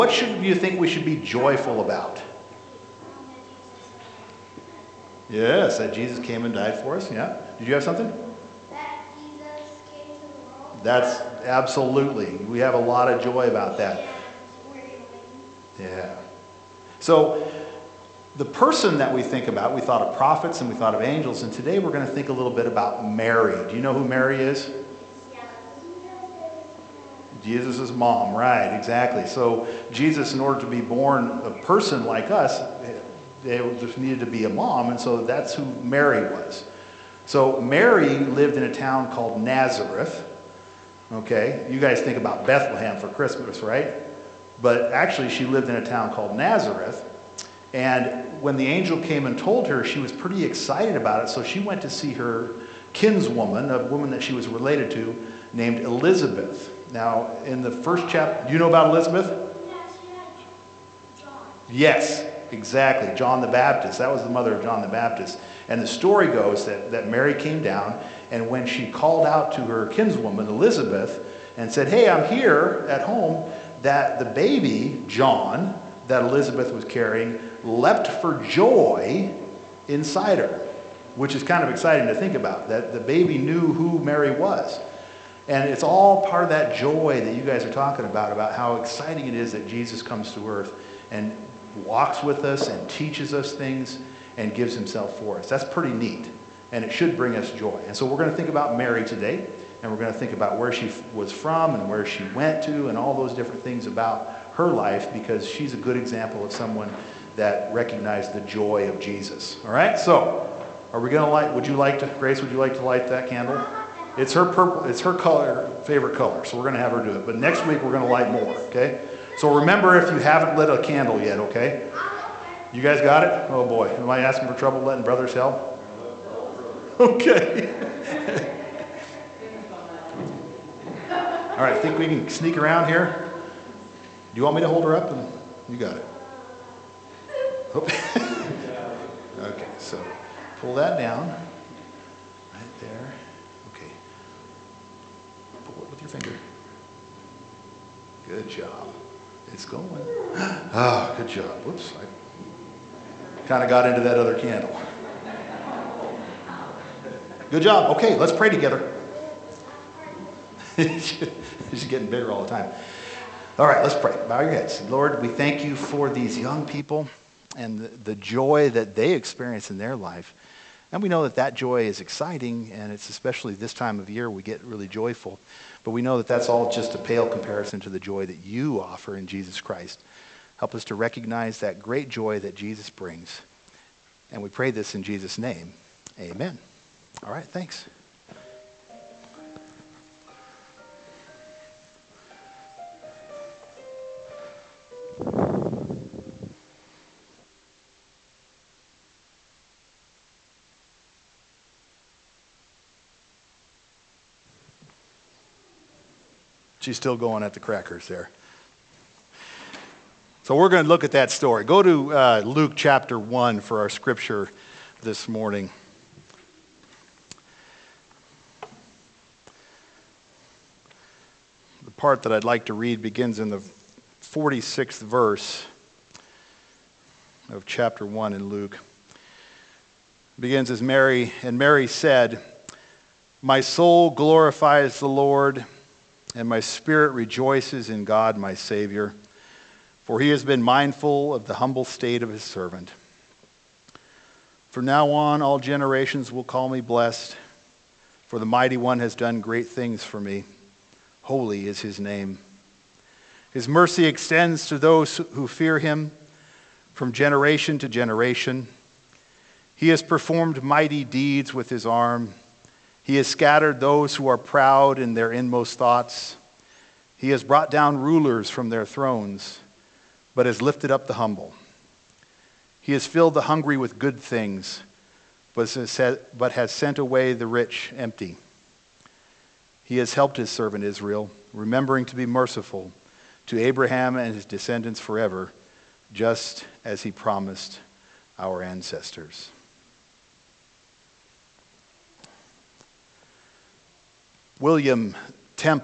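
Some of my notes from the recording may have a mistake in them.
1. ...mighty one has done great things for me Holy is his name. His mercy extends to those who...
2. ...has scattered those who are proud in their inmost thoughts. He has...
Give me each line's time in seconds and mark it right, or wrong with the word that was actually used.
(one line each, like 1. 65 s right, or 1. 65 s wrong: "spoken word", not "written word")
1. 248 s right
2. 263 s right.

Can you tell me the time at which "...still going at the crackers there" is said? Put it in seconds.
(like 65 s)
206 s.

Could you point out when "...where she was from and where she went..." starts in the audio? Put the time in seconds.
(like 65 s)
100 s.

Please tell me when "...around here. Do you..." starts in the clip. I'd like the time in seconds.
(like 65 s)
132 s.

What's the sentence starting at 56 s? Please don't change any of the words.
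Now, in the first chapter, do you know about Elizabeth?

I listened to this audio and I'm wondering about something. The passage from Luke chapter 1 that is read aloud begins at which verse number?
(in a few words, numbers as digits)
46.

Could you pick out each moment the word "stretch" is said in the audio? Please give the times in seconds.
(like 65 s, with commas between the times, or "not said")
not said.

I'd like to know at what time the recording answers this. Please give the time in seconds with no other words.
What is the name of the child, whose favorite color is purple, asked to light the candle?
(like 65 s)
112 s.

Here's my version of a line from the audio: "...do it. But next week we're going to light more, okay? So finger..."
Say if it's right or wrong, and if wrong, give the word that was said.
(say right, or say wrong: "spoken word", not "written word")
wrong: "remember", not "finger".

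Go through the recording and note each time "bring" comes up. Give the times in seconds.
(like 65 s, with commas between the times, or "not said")
97 s, 182 s.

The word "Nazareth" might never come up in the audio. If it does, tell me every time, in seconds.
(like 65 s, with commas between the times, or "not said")
39 s, 46 s.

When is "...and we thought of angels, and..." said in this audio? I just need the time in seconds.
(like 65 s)
20 s.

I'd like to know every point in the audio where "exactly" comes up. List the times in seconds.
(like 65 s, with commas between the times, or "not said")
28 s, 62 s.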